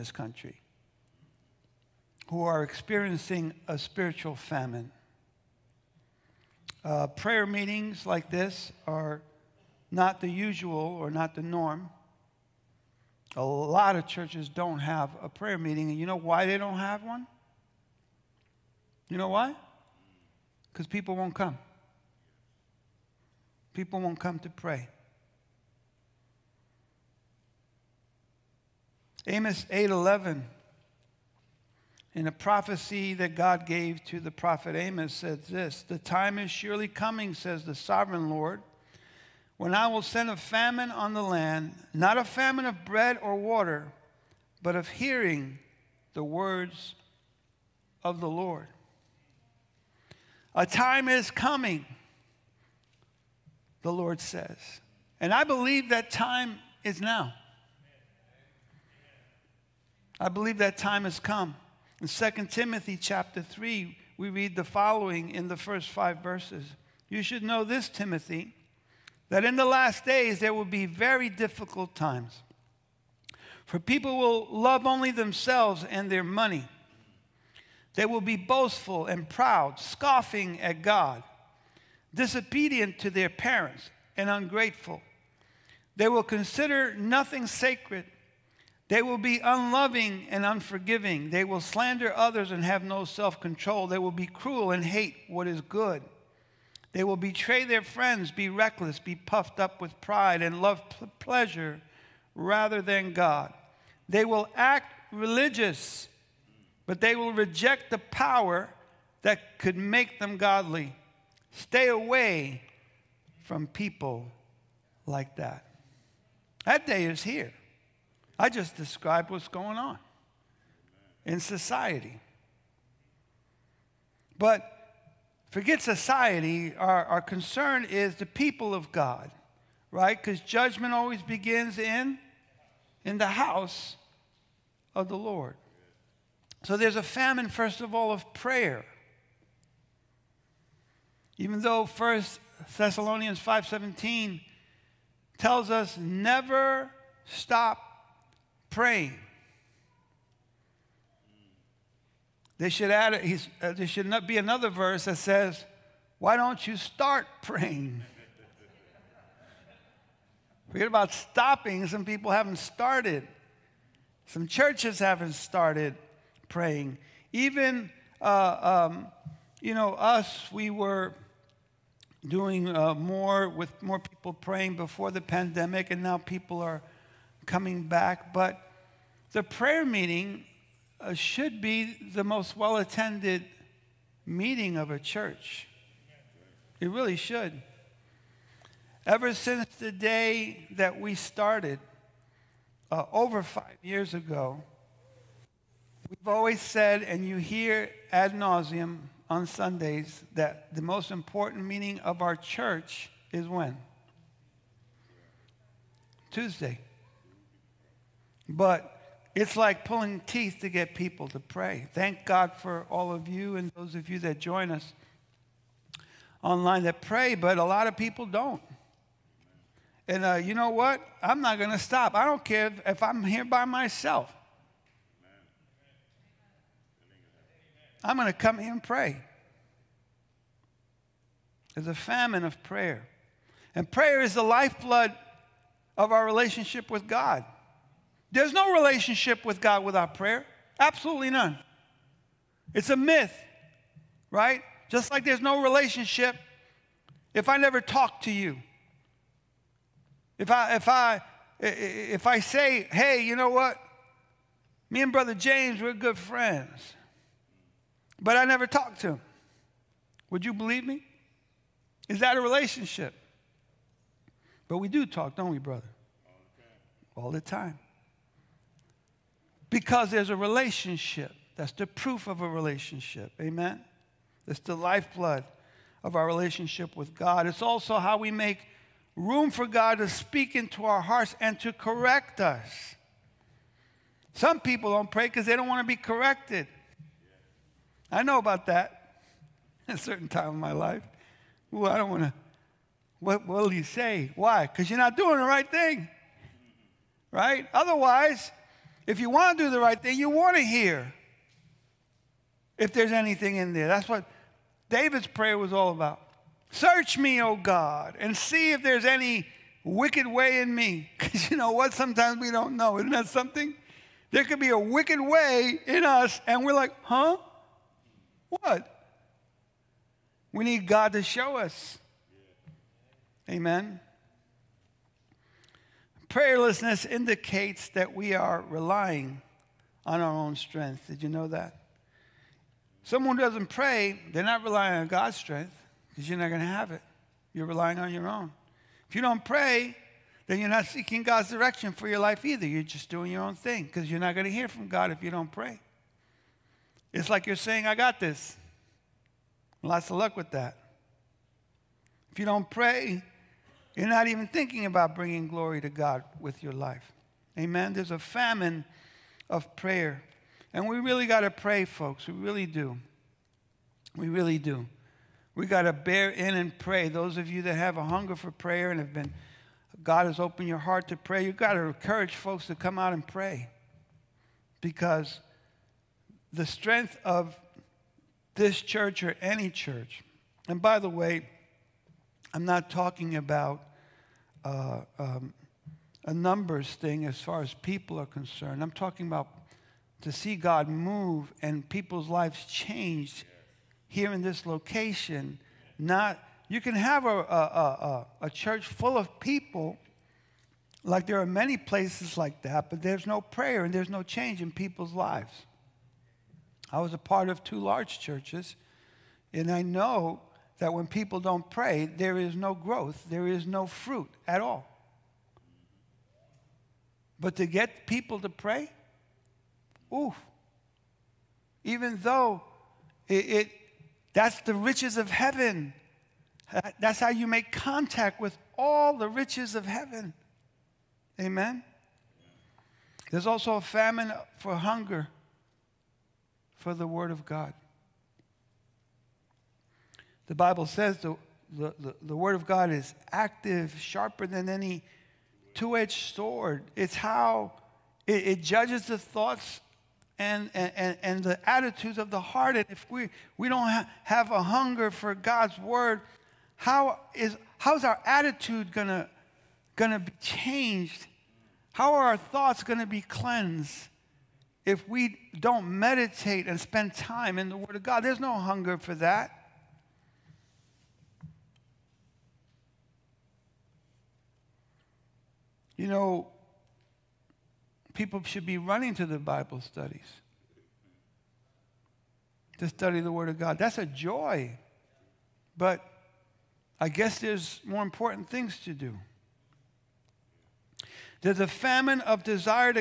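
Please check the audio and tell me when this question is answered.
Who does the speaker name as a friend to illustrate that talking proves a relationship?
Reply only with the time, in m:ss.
4:15.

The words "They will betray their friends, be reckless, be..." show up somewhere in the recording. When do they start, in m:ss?
1:36.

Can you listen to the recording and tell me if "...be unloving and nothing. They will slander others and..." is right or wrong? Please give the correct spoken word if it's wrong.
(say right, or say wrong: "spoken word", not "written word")
wrong: "unforgiving", not "nothing".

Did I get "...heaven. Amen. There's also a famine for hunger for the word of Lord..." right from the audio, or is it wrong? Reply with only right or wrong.
wrong.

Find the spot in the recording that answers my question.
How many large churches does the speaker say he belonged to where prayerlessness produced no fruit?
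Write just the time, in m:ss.
6:47.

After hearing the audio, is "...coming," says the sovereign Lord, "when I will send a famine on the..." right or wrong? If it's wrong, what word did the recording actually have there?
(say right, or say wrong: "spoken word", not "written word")
right.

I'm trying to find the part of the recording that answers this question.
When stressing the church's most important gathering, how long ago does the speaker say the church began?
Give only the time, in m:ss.
3:13.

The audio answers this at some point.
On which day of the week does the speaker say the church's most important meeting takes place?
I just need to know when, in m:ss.
3:26.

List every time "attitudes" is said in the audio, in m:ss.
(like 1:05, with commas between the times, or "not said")
7:31, 7:38.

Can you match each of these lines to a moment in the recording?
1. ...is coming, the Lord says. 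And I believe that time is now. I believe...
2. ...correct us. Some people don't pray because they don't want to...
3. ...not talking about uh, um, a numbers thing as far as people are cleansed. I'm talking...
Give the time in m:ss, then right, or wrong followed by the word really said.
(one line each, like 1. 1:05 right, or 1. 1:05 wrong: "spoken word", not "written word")
1. 0:51 right
2. 4:41 right
3. 6:22 wrong: "concerned", not "cleansed".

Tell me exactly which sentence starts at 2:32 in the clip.
They should add, uh, there should not be another verse that says, Why don't you start praying?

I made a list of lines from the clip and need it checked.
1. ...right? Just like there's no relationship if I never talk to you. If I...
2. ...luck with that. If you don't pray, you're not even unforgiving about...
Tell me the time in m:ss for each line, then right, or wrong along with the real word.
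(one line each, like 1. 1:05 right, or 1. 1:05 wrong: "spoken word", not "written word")
1. 4:04 right
2. 5:50 wrong: "thinking", not "unforgiving".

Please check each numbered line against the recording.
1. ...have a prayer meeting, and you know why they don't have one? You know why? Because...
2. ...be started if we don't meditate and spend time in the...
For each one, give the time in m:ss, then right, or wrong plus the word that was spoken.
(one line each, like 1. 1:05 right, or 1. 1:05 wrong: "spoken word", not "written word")
1. 0:14 right
2. 7:43 wrong: "cleansed", not "started".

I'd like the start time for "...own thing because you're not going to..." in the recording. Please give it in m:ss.
5:43.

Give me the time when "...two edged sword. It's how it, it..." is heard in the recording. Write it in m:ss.
7:25.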